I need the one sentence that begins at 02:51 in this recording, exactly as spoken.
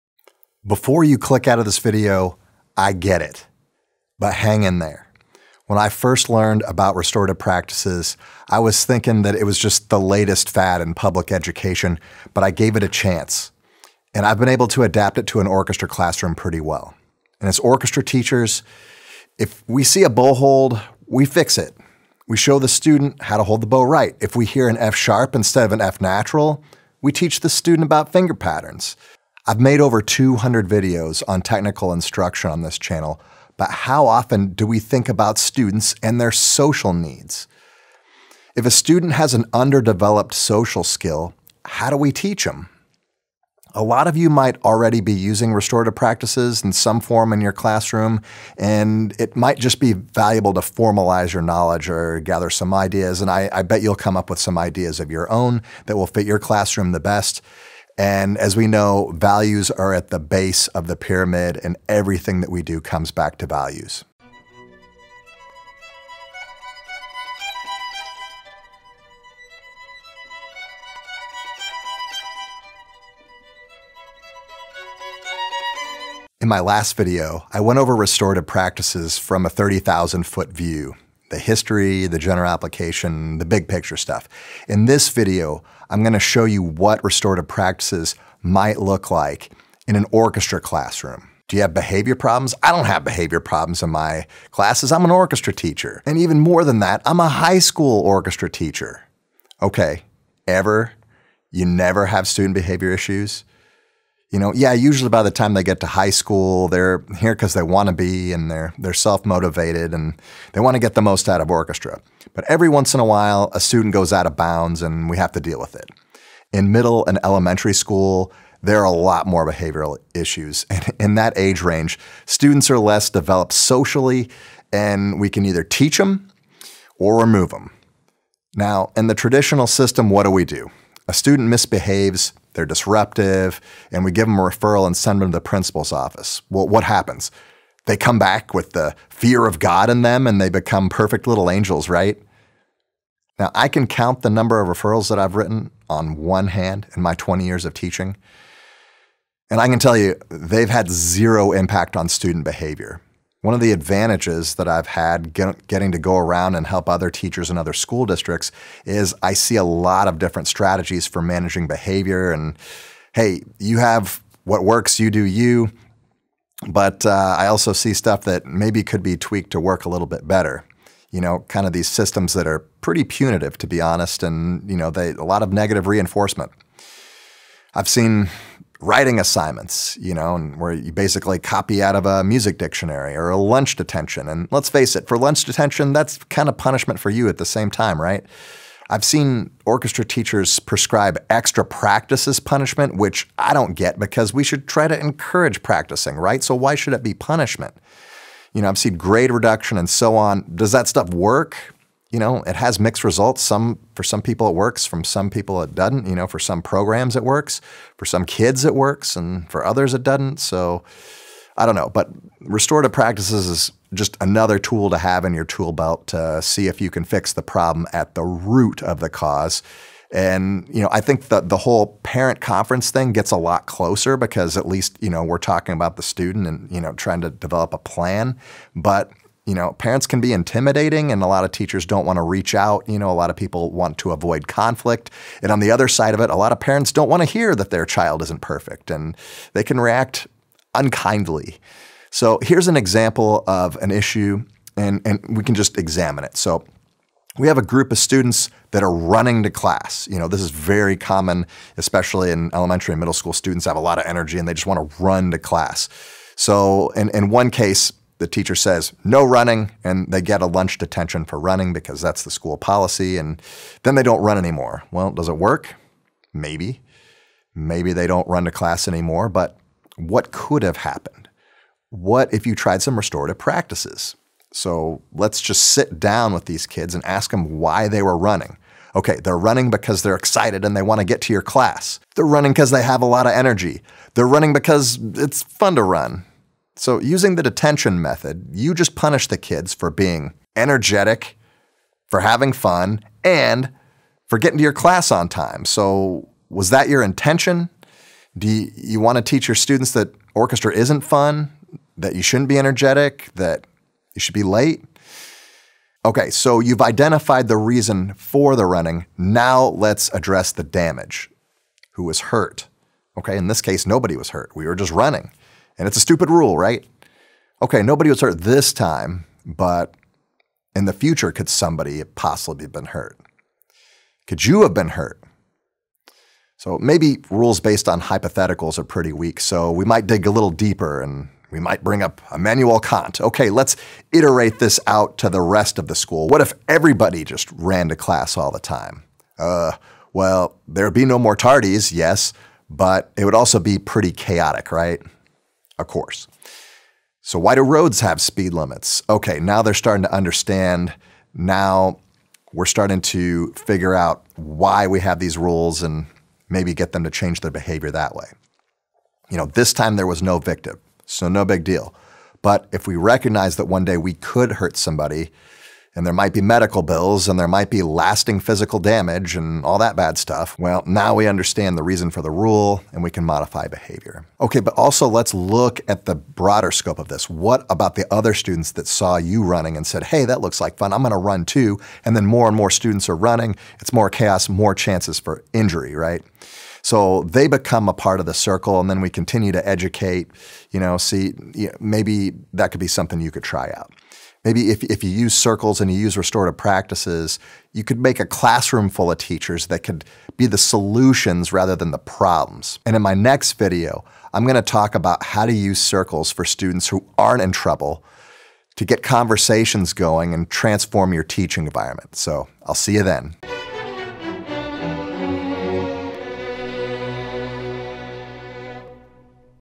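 You know, kind of these systems that are pretty punitive, to be honest, and you know, they a lot of negative reinforcement.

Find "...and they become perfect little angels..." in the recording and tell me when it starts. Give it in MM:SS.
02:20.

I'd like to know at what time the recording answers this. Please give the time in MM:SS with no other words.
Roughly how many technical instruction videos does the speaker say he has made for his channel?
00:29.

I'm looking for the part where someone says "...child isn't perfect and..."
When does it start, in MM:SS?
03:57.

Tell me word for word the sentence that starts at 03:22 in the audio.
you know, it has mixed results.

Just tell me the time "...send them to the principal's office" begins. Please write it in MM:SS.
02:14.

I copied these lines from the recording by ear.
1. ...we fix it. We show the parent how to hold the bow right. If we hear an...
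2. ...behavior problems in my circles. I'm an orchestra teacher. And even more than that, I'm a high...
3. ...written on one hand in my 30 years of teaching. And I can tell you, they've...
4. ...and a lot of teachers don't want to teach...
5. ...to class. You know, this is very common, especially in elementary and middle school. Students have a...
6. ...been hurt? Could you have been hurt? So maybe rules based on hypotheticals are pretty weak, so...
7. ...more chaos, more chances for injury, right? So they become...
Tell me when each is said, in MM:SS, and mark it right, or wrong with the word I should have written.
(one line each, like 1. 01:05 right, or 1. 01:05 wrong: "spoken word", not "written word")
1. 00:21 wrong: "student", not "parent"
2. 01:33 wrong: "classes", not "circles"
3. 02:25 wrong: "20", not "30"
4. 03:51 wrong: "reach", not "teach"
5. 04:09 right
6. 05:22 right
7. 06:23 right.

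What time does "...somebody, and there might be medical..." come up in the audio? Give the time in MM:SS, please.
06:04.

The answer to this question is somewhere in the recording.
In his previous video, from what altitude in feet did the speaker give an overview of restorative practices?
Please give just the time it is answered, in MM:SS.
01:19.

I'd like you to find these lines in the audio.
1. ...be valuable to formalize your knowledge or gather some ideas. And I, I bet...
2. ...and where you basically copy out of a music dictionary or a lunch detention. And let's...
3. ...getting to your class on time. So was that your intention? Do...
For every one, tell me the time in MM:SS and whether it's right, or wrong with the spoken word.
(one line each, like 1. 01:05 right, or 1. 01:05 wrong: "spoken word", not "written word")
1. 00:49 right
2. 03:00 right
3. 04:54 right.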